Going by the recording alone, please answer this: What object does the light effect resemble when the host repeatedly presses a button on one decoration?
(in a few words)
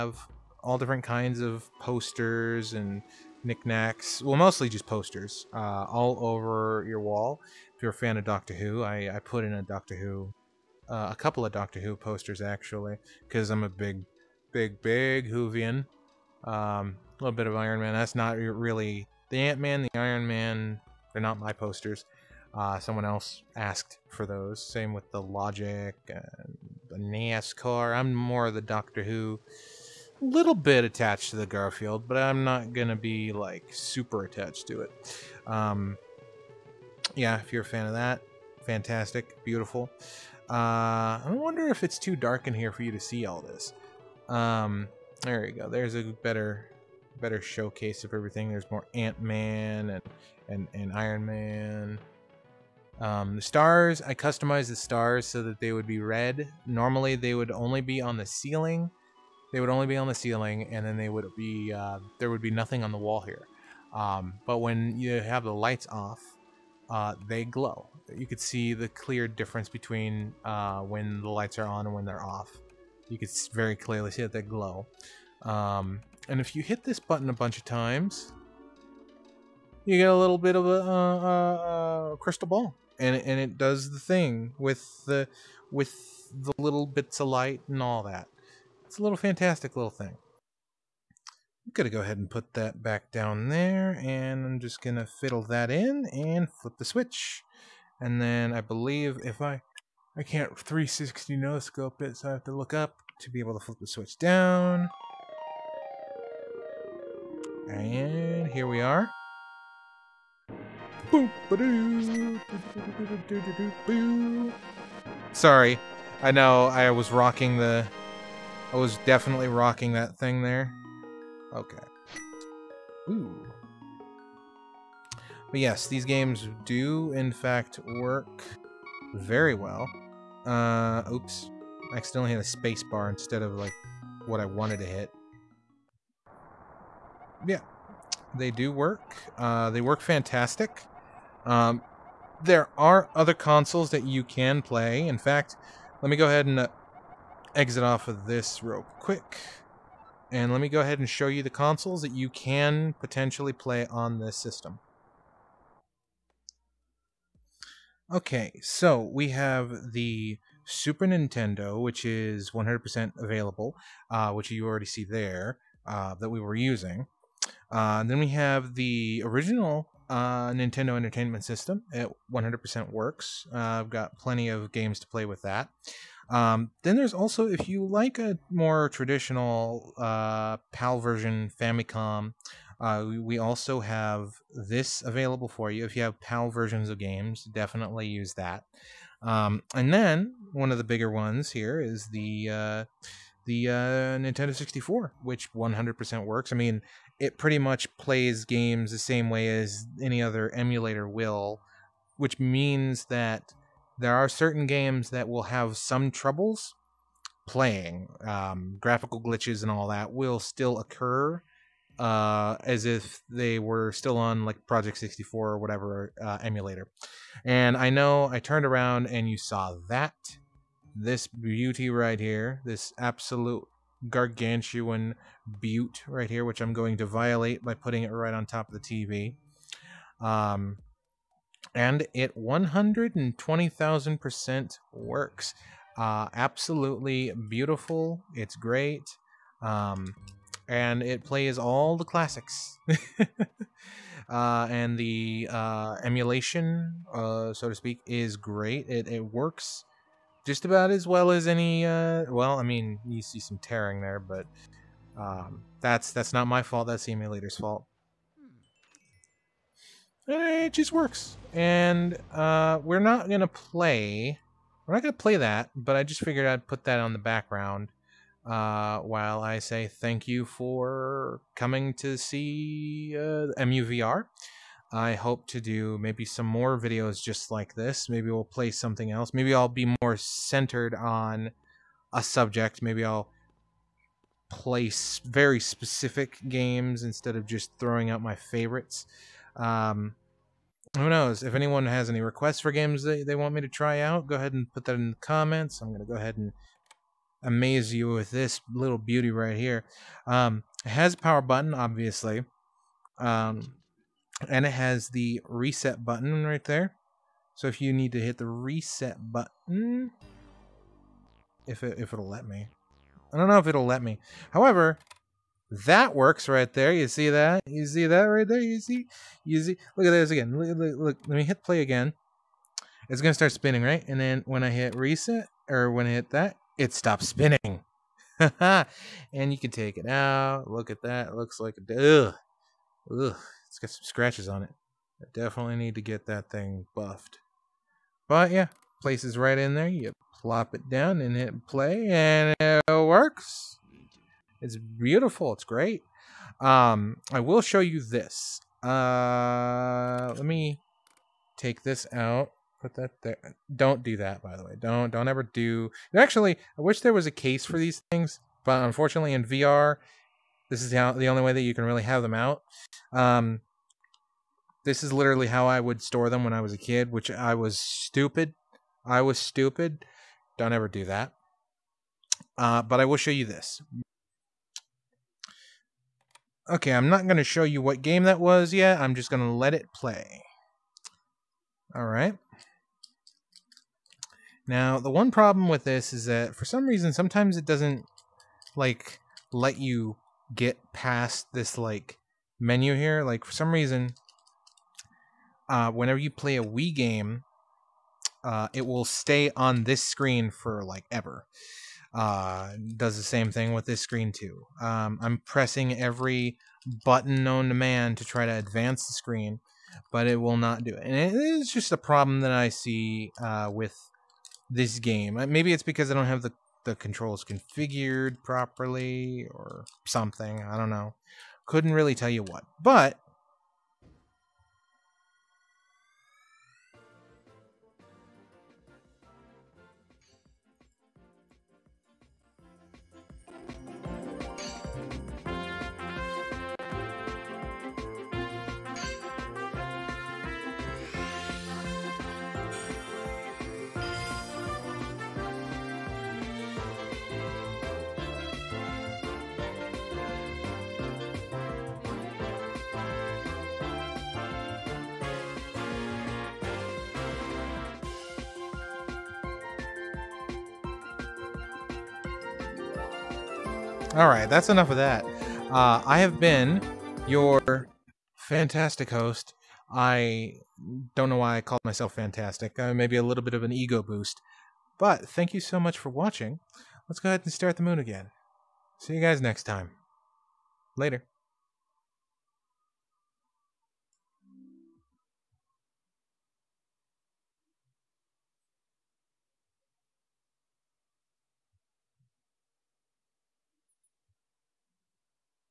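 Crystal ball.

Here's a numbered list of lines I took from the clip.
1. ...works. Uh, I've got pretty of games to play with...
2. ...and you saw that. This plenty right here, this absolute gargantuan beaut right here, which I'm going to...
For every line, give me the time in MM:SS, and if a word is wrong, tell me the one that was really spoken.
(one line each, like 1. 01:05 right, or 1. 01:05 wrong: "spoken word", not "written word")
1. 02:52 wrong: "plenty", not "pretty"
2. 03:39 wrong: "beauty", not "plenty".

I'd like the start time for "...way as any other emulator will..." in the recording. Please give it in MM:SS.
03:19.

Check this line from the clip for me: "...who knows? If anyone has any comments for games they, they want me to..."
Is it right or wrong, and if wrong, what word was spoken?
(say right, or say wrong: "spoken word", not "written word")
wrong: "requests", not "comments".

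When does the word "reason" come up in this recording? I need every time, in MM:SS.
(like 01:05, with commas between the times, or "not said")
06:26, 06:33.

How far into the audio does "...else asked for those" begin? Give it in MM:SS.
00:23.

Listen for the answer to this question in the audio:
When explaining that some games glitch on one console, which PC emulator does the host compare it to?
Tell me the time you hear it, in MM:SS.
03:34.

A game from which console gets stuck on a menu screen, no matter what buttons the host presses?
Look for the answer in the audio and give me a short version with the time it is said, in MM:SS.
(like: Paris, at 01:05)
Wii, at 06:36.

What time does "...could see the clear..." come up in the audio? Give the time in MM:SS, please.
01:08.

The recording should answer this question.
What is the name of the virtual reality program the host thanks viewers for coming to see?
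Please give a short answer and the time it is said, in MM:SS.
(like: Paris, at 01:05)
Emu VR, at 04:33.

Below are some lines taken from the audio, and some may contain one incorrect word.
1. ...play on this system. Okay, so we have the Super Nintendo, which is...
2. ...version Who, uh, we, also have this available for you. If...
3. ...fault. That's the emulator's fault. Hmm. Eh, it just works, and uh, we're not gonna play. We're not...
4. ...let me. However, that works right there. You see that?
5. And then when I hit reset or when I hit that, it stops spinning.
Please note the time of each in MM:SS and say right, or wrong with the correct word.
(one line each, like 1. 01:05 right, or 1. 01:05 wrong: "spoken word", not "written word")
1. 02:33 right
2. 03:00 wrong: "Famicom", not "Who"
3. 04:16 right
4. 05:13 right
5. 05:24 right.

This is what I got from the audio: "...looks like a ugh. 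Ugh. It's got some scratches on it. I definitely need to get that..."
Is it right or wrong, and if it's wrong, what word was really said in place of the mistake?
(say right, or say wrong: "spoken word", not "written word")
right.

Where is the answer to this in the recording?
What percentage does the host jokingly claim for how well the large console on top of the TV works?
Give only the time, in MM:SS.
03:52.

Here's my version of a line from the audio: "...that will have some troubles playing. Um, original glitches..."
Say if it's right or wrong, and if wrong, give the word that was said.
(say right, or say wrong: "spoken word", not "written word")
wrong: "graphical", not "original".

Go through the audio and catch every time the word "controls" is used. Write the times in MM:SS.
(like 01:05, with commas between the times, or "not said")
06:56.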